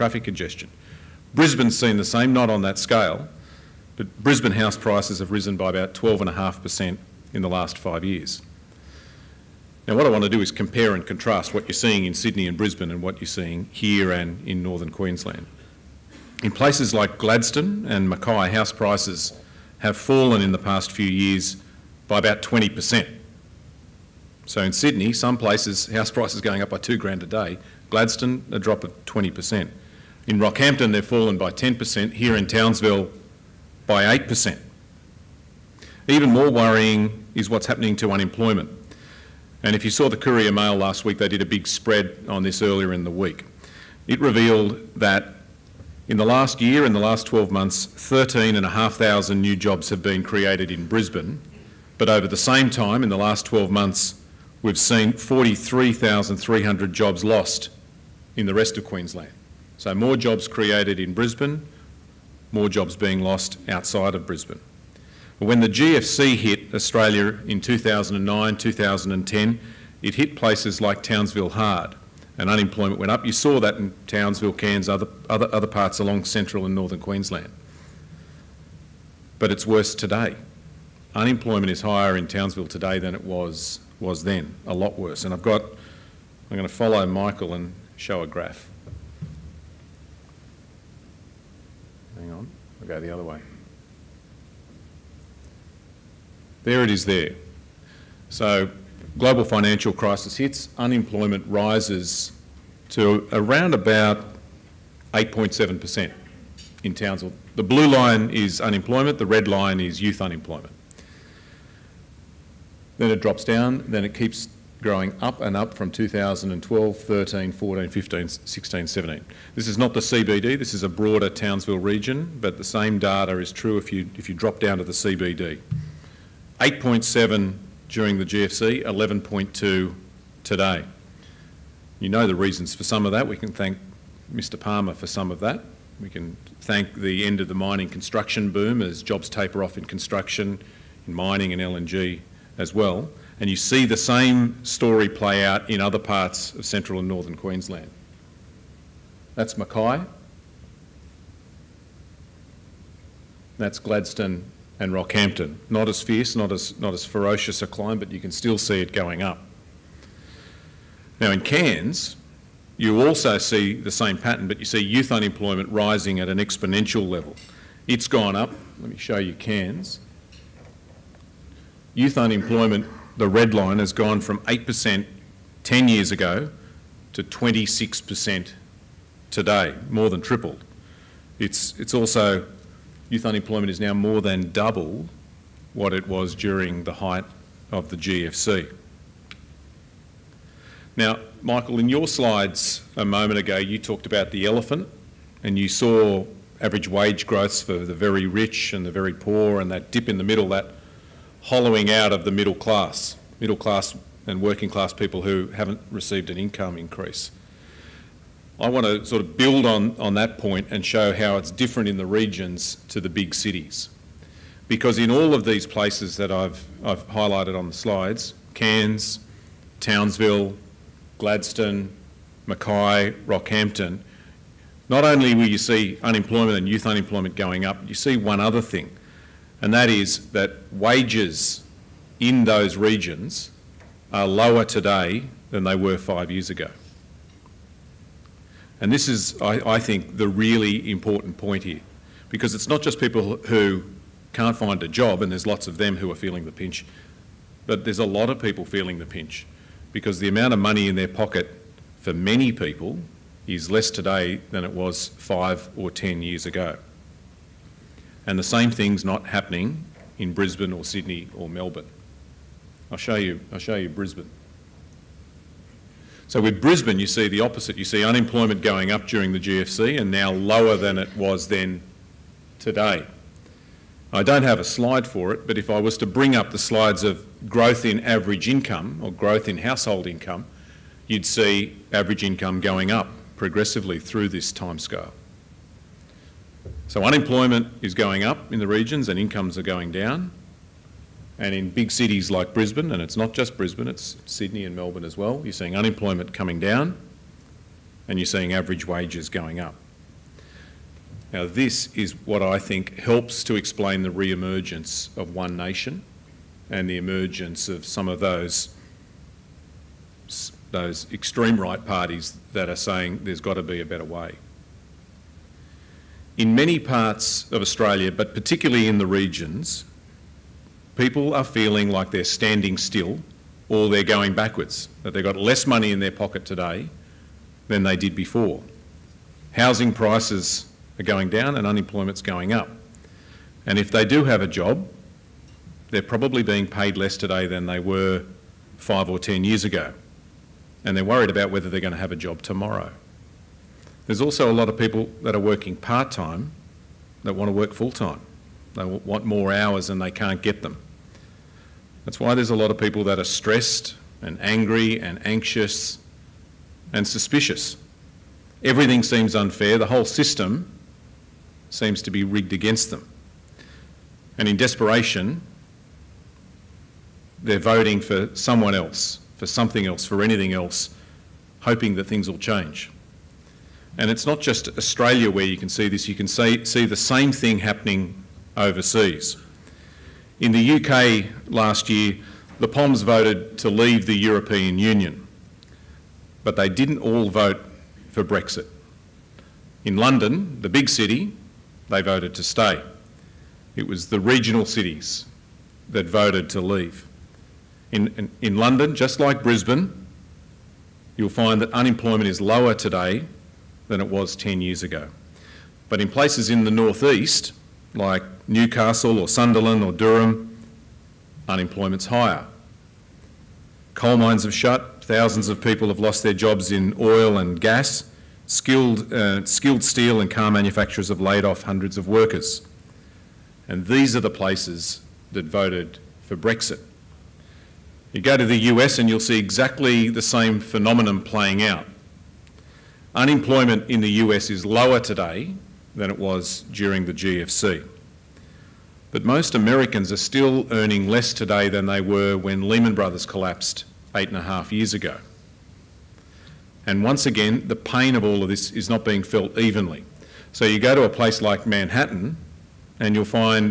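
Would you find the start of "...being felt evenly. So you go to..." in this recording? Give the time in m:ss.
7:29.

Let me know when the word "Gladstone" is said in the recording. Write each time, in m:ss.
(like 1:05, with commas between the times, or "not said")
0:17, 0:27, 2:33, 3:41.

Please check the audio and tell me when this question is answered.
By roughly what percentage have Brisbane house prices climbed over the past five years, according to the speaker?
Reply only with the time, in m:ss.
0:05.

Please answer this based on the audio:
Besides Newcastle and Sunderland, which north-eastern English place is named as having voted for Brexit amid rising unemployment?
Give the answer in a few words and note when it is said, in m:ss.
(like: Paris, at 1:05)
Durham, at 6:49.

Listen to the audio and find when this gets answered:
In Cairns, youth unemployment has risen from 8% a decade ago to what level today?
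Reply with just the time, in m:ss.
2:57.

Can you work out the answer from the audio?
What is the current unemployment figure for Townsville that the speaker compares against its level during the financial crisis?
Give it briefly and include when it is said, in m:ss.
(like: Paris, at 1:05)
11.2, at 2:08.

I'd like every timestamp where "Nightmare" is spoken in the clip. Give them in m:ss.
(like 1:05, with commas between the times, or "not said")
not said.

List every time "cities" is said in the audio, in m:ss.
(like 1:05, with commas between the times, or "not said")
3:33, 4:51, 6:34.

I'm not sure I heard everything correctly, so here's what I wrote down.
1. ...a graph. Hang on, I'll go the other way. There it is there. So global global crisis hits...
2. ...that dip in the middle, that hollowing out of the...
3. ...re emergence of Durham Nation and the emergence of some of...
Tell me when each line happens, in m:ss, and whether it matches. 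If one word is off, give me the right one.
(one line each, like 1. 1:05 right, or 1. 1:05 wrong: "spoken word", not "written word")
1. 1:28 wrong: "financial", not "global"
2. 3:19 right
3. 5:04 wrong: "One", not "Durham".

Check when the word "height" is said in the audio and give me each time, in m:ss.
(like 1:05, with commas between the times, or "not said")
3:06.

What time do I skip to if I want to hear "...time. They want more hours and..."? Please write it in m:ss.
5:47.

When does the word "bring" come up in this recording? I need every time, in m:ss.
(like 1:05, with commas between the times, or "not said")
4:36.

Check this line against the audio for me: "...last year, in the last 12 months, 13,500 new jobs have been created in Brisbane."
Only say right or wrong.
right.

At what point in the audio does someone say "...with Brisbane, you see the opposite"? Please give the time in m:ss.
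4:26.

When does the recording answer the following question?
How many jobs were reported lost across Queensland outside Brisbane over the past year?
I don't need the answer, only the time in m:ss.
0:55.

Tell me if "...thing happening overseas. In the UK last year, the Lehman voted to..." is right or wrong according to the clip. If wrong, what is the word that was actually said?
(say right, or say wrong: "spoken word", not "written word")
wrong: "POMs", not "Lehman".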